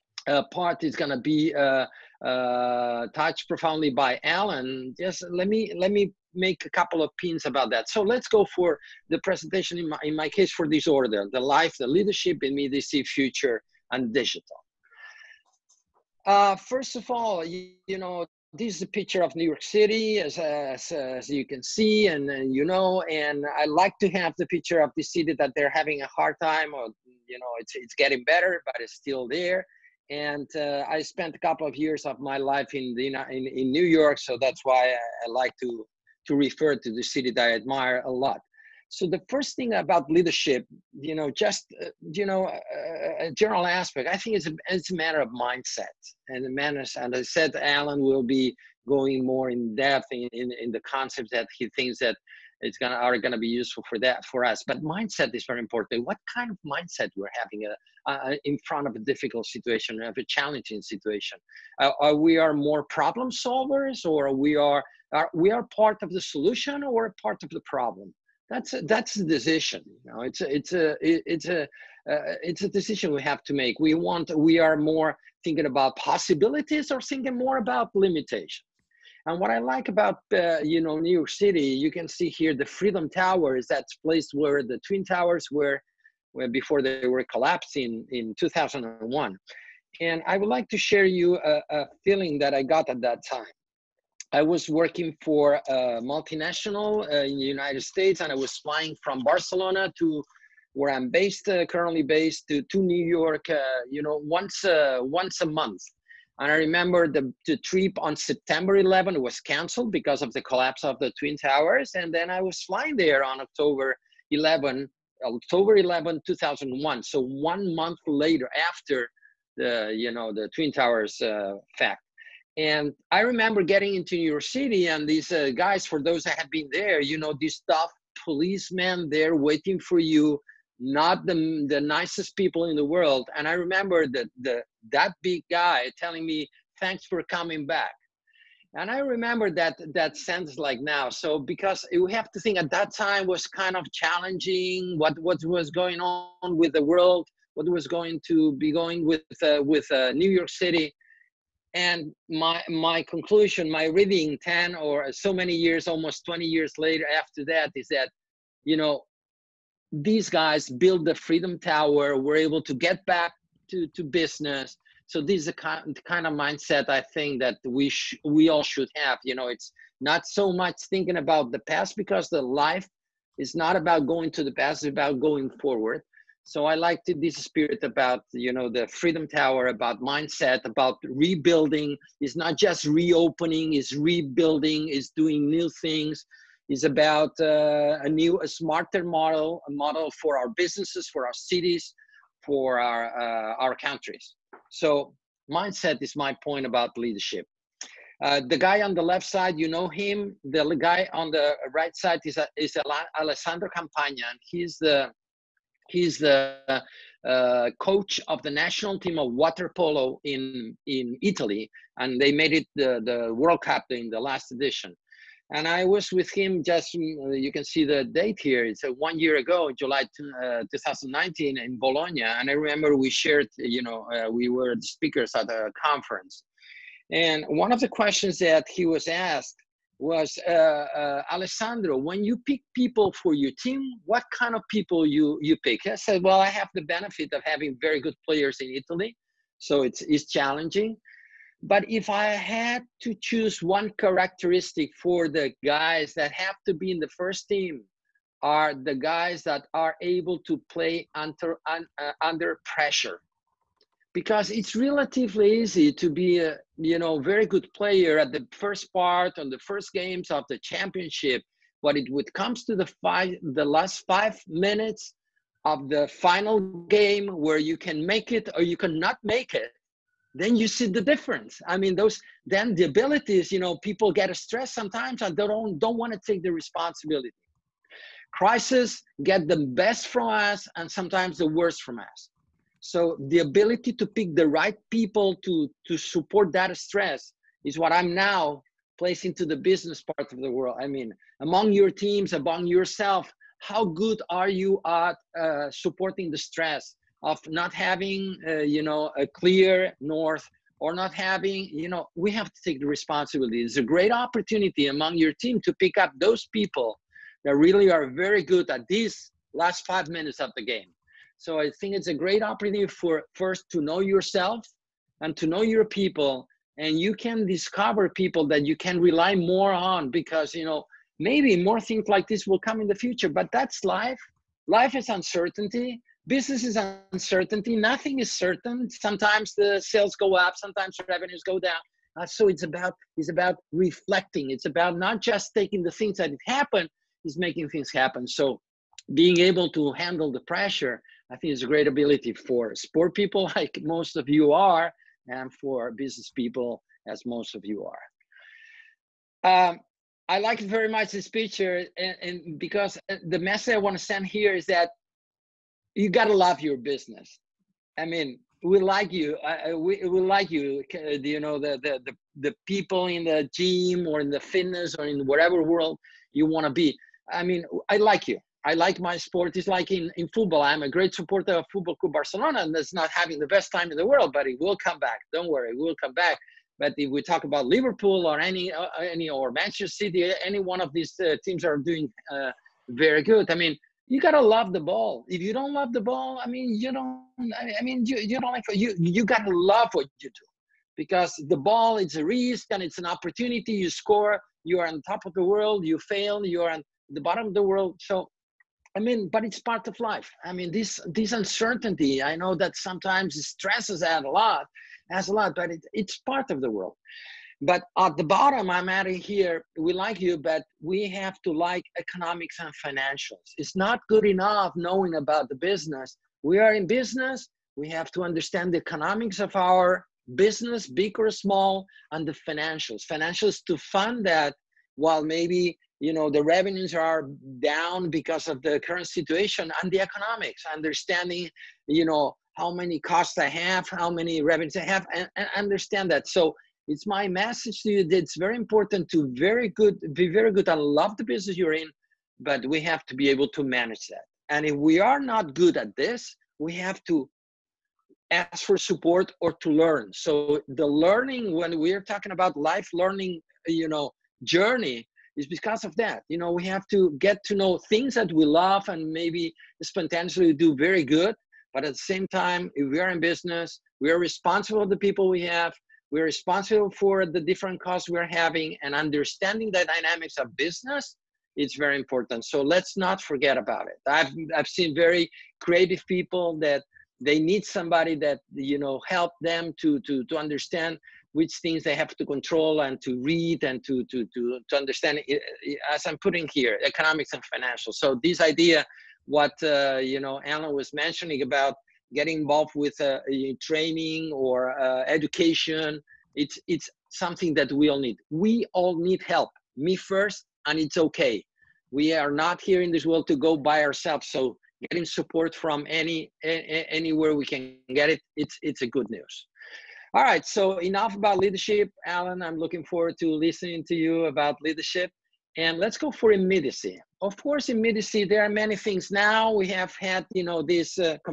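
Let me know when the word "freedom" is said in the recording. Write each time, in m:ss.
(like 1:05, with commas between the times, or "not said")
1:22, 2:41, 2:59.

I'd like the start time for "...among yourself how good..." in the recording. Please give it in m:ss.
4:52.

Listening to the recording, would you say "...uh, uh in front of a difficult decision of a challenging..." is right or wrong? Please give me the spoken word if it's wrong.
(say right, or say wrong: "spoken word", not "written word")
wrong: "situation", not "decision".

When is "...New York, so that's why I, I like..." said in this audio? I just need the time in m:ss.
0:33.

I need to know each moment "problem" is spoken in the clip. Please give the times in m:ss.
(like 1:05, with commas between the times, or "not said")
1:02, 1:07.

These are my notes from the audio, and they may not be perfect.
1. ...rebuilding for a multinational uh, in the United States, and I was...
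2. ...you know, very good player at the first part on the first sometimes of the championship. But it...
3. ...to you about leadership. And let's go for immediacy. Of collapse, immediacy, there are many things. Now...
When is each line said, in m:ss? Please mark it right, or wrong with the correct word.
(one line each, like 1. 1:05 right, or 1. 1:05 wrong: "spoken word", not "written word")
1. 1:34 wrong: "working", not "rebuilding"
2. 4:16 wrong: "games", not "sometimes"
3. 8:33 wrong: "course", not "collapse".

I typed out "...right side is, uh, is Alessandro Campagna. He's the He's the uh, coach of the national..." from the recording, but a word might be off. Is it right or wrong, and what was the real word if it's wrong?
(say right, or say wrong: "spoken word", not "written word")
right.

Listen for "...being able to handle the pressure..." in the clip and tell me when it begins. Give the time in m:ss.
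5:39.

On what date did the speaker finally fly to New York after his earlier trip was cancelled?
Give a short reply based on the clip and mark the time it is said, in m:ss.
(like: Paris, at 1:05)
October 11, 2001, at 1:55.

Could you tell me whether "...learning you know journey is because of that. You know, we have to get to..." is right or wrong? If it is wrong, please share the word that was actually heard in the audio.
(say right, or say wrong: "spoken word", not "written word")
right.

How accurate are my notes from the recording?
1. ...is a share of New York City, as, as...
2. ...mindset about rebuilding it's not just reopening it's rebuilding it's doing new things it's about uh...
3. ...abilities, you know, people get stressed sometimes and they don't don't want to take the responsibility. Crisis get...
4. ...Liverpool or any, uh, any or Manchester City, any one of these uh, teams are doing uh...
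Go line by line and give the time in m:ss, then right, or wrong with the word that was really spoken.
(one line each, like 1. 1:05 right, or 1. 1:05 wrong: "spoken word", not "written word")
1. 0:18 wrong: "picture", not "share"
2. 3:00 right
3. 4:32 right
4. 6:17 right.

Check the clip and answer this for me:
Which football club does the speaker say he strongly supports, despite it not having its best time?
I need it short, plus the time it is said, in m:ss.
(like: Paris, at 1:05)
Football Club Barcelona, at 6:11.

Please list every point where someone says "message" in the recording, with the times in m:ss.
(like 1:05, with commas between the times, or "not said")
5:53, 7:17.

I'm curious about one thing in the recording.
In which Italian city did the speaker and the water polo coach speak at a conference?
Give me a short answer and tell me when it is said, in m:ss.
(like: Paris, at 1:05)
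Bologna, at 3:41.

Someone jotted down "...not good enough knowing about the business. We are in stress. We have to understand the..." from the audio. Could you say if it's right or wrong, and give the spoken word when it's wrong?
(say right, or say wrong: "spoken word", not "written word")
wrong: "business", not "stress".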